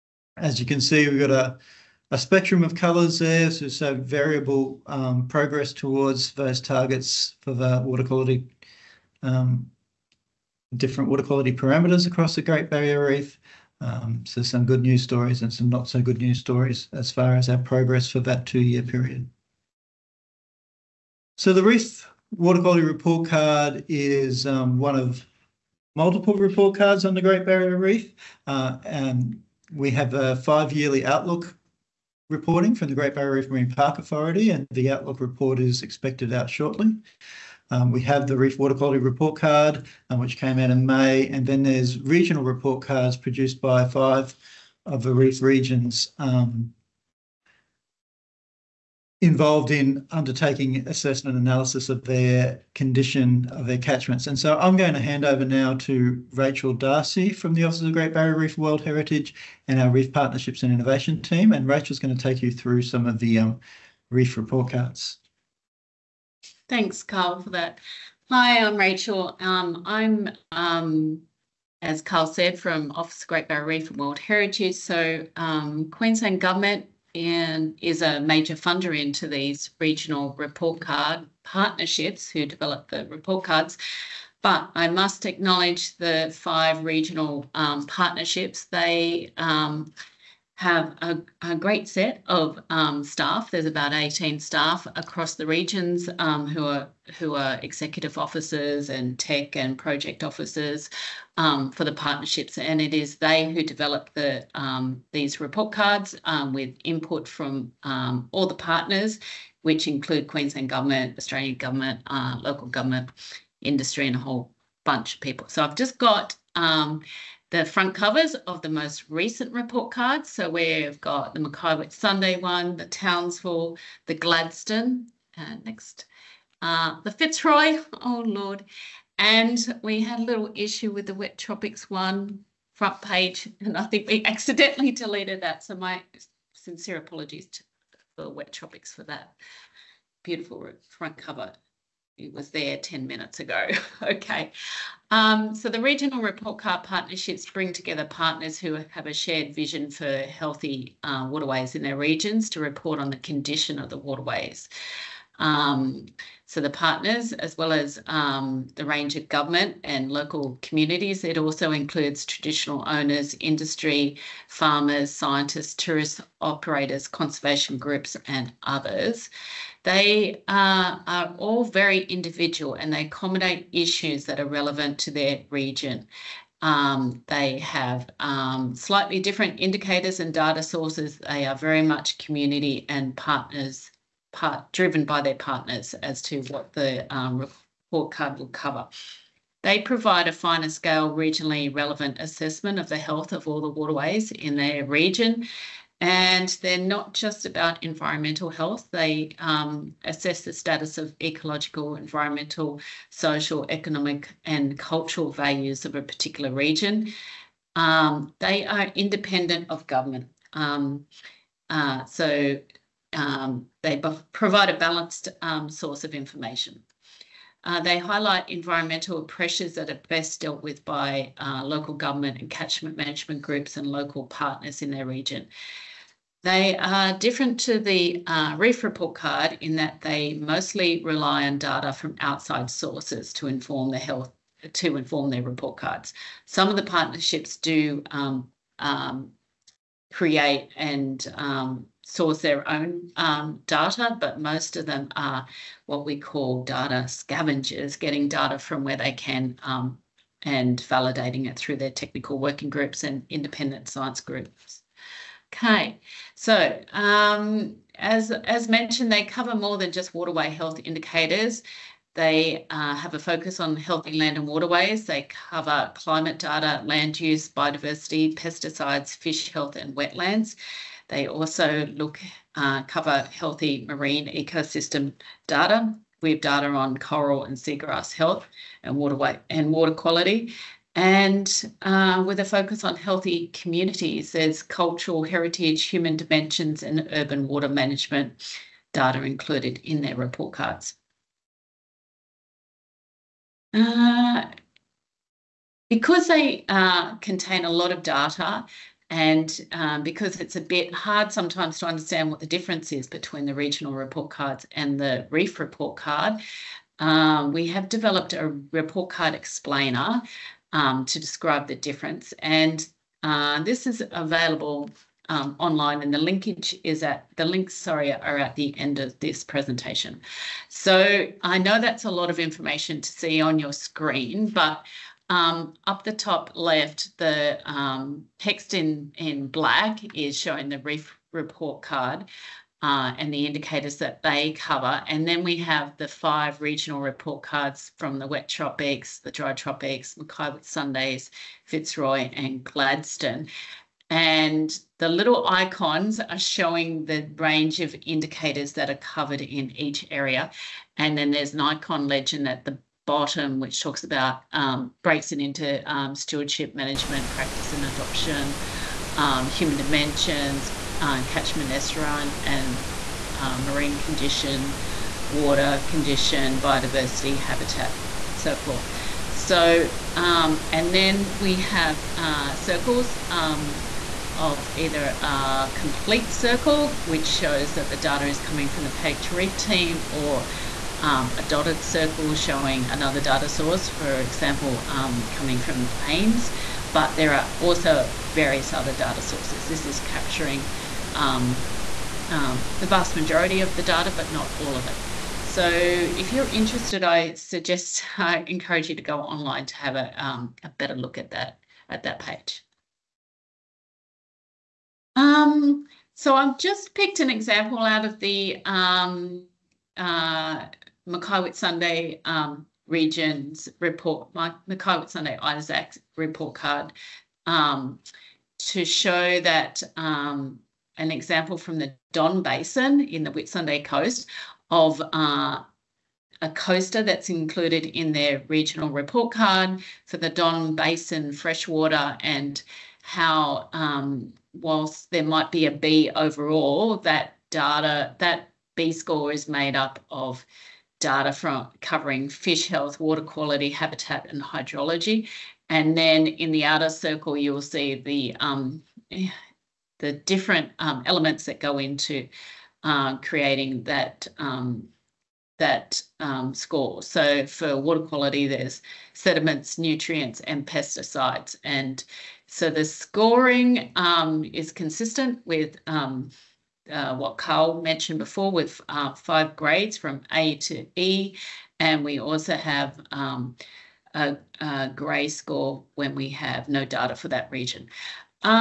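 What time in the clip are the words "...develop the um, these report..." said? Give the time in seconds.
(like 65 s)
103 s.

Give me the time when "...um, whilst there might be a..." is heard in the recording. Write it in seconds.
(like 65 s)
433 s.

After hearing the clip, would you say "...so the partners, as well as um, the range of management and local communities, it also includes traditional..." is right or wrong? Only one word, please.
wrong.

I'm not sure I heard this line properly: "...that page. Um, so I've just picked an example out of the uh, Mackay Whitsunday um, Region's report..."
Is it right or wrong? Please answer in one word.
right.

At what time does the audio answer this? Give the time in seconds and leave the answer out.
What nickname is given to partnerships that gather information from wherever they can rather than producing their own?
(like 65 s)
246 s.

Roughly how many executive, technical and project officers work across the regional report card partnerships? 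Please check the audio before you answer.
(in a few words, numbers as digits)
About 18.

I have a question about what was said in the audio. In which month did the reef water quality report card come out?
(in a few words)
May.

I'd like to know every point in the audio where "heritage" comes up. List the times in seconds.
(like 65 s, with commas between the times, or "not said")
58 s, 74 s, 285 s.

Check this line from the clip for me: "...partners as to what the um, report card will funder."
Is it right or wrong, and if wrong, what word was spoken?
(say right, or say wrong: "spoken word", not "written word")
wrong: "cover", not "funder".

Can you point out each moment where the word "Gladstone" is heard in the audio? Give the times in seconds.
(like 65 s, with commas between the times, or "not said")
124 s, 342 s.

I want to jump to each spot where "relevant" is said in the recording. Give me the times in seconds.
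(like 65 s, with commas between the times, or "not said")
174 s, 191 s.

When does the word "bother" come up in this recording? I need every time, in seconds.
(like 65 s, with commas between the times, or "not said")
not said.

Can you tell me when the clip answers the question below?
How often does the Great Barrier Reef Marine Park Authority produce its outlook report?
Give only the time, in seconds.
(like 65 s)
30 s.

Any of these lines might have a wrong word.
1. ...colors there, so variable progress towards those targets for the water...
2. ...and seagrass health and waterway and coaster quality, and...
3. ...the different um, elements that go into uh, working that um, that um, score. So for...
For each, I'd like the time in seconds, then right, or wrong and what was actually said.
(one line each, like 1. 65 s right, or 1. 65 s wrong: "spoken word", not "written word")
1. 2 s right
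2. 277 s wrong: "water", not "coaster"
3. 449 s wrong: "creating", not "working".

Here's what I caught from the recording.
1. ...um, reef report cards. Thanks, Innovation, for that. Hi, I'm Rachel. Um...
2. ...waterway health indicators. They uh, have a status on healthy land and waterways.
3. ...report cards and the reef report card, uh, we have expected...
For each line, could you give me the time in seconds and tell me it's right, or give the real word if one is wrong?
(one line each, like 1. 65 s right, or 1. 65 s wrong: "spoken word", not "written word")
1. 63 s wrong: "Carl", not "Innovation"
2. 260 s wrong: "focus", not "status"
3. 303 s wrong: "developed", not "expected".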